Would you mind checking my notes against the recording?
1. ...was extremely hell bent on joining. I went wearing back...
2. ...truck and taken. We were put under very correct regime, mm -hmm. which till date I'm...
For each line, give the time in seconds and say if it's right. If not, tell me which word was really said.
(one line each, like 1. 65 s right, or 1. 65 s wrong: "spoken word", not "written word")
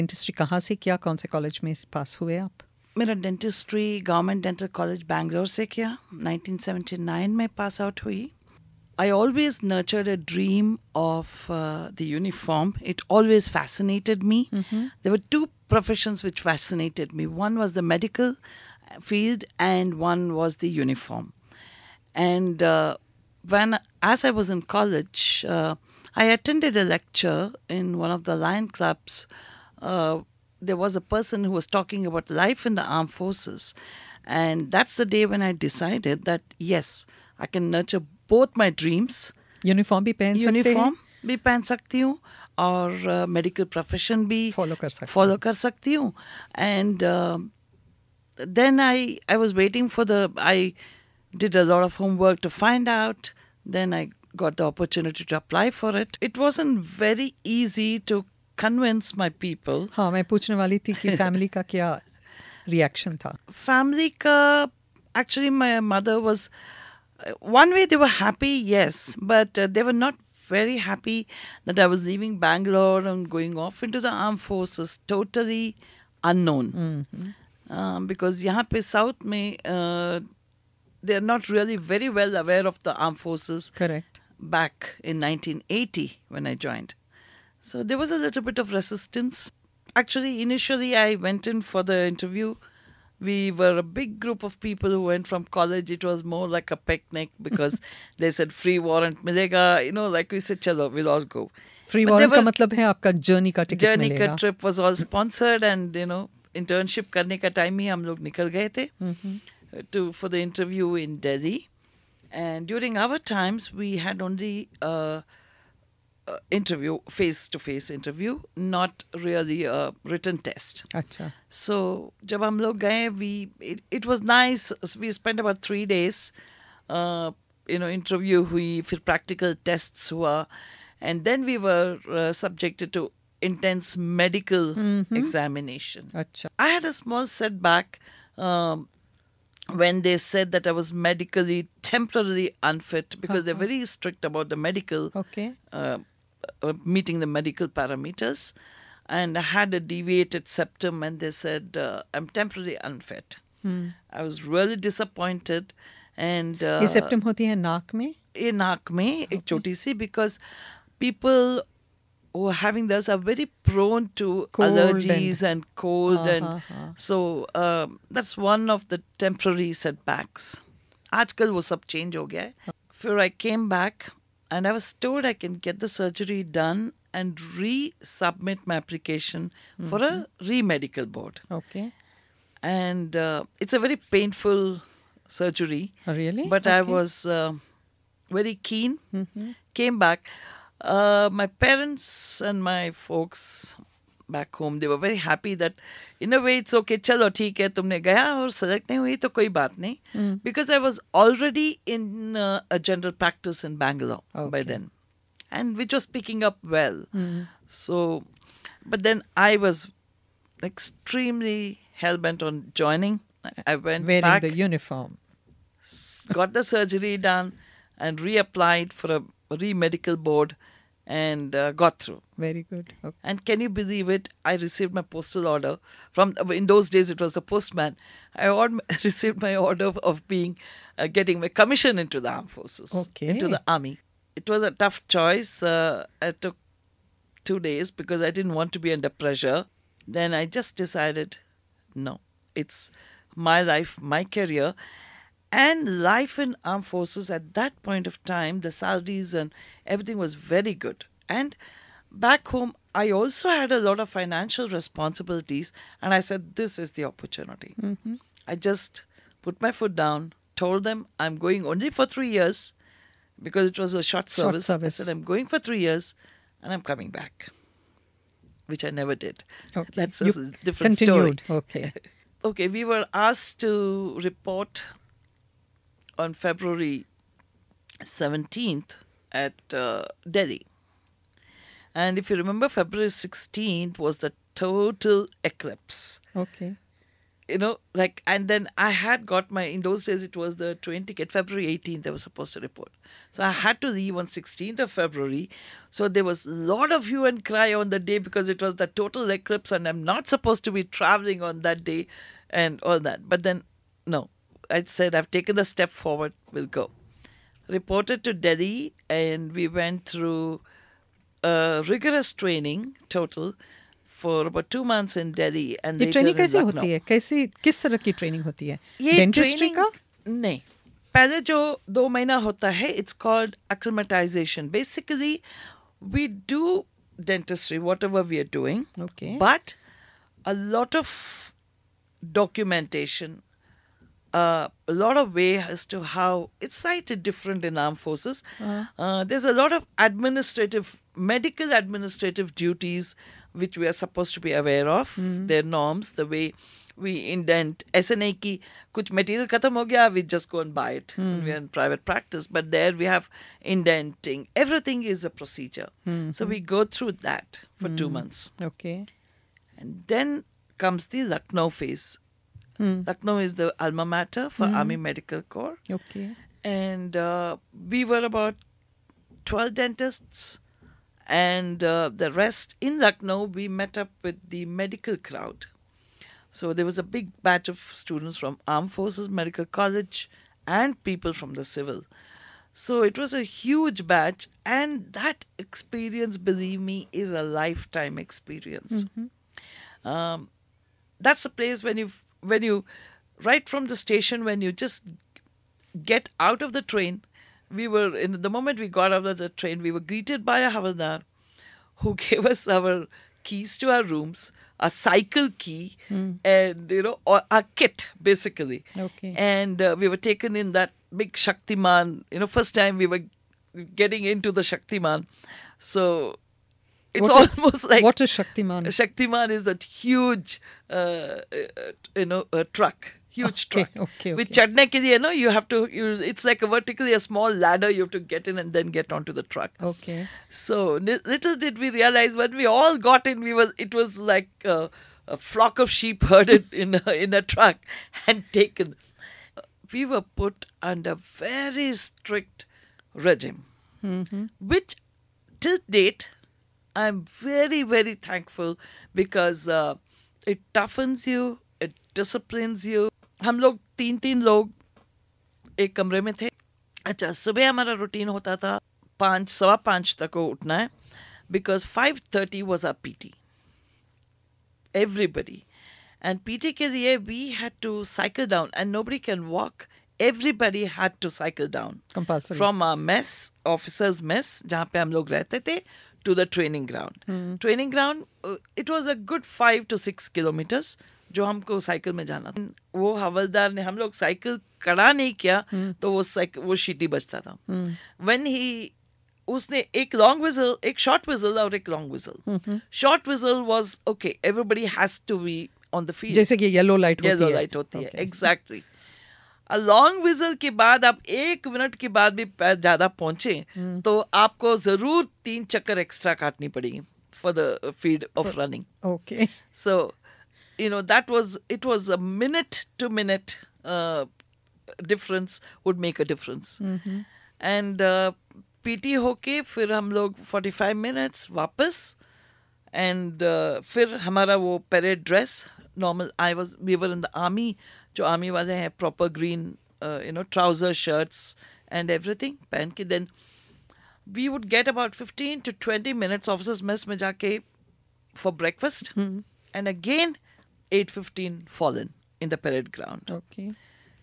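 1. 209 s right
2. 437 s wrong: "strict", not "correct".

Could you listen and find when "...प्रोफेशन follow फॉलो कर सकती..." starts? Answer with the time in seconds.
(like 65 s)
44 s.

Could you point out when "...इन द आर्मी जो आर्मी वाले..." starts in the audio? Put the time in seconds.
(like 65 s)
527 s.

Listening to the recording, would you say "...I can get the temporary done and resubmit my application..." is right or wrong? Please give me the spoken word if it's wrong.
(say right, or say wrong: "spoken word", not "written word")
wrong: "surgery", not "temporary".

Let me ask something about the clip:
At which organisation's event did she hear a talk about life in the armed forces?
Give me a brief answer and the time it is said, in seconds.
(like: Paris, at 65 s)
Lion Clubs, at 28 s.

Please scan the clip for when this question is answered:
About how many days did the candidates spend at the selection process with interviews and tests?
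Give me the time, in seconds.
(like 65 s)
125 s.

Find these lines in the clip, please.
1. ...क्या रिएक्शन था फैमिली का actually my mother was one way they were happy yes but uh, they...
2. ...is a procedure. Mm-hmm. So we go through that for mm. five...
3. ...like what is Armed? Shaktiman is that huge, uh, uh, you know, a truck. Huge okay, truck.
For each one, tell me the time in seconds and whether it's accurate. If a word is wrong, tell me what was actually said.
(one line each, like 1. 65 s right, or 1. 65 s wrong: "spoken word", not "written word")
1. 61 s right
2. 355 s wrong: "two", not "five"
3. 417 s wrong: "Shaktiman", not "Armed".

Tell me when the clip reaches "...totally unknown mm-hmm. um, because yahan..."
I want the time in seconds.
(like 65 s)
75 s.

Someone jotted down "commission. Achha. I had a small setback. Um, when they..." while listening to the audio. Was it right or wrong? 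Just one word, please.
wrong.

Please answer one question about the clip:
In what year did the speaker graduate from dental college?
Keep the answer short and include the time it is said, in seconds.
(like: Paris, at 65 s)
1979, at 6 s.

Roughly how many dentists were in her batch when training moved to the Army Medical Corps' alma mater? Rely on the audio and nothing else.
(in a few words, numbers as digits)
12.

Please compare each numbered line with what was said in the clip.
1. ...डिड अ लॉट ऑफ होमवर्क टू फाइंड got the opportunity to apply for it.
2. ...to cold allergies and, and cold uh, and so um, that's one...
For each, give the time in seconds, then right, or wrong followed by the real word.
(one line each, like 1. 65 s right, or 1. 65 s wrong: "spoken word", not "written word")
1. 51 s right
2. 164 s right.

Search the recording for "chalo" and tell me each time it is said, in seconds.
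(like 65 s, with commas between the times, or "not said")
100 s, 196 s.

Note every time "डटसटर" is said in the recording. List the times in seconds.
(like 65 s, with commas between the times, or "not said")
3 s, 319 s.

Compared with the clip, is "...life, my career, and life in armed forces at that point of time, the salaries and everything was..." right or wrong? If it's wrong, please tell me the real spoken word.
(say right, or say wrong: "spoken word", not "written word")
right.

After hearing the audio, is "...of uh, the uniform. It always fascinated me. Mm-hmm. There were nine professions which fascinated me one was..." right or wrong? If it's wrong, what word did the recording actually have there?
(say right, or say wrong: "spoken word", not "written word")
wrong: "two", not "nine".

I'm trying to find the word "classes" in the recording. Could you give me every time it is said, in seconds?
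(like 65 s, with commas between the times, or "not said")
not said.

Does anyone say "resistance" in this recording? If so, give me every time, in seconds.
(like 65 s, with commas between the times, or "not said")
88 s.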